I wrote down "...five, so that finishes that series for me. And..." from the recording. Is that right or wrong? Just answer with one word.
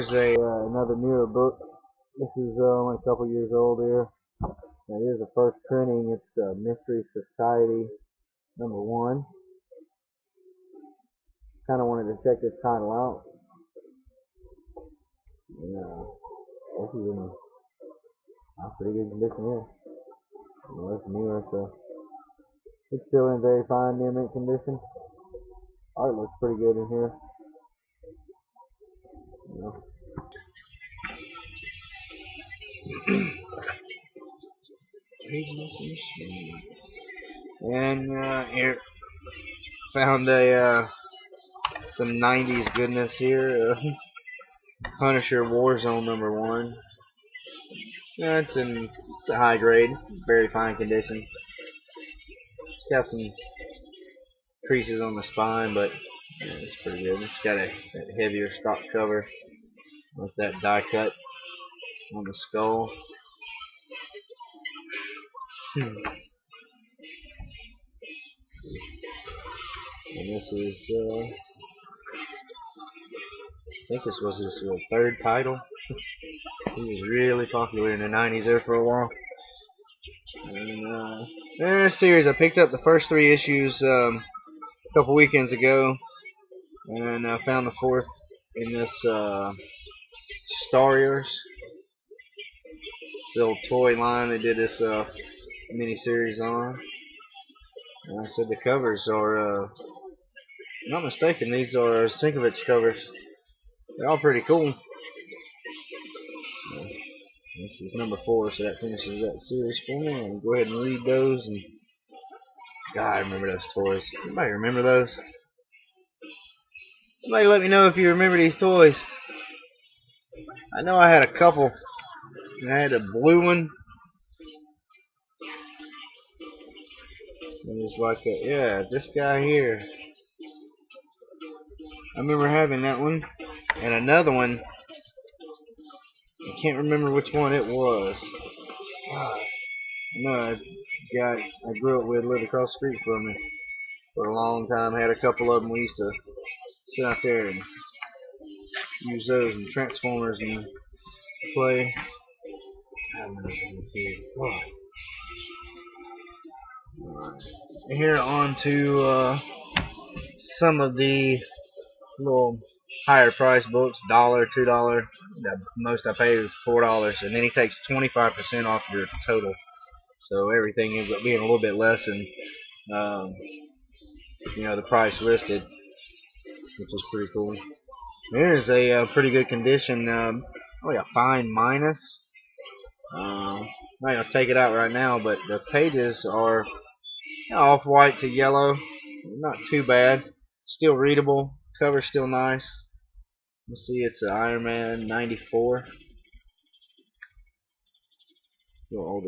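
wrong.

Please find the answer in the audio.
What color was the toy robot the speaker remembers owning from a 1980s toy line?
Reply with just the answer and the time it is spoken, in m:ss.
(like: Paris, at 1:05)
Blue, at 2:02.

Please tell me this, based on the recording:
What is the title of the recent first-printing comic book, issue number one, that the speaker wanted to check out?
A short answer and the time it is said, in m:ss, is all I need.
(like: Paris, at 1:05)
Mystery Society, at 0:06.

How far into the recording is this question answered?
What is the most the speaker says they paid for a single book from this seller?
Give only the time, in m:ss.
2:46.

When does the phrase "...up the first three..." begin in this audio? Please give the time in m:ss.
1:22.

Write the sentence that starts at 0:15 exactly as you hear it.
And, uh, this is in pretty good condition here.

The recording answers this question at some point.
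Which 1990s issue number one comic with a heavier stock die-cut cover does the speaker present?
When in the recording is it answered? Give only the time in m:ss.
0:44.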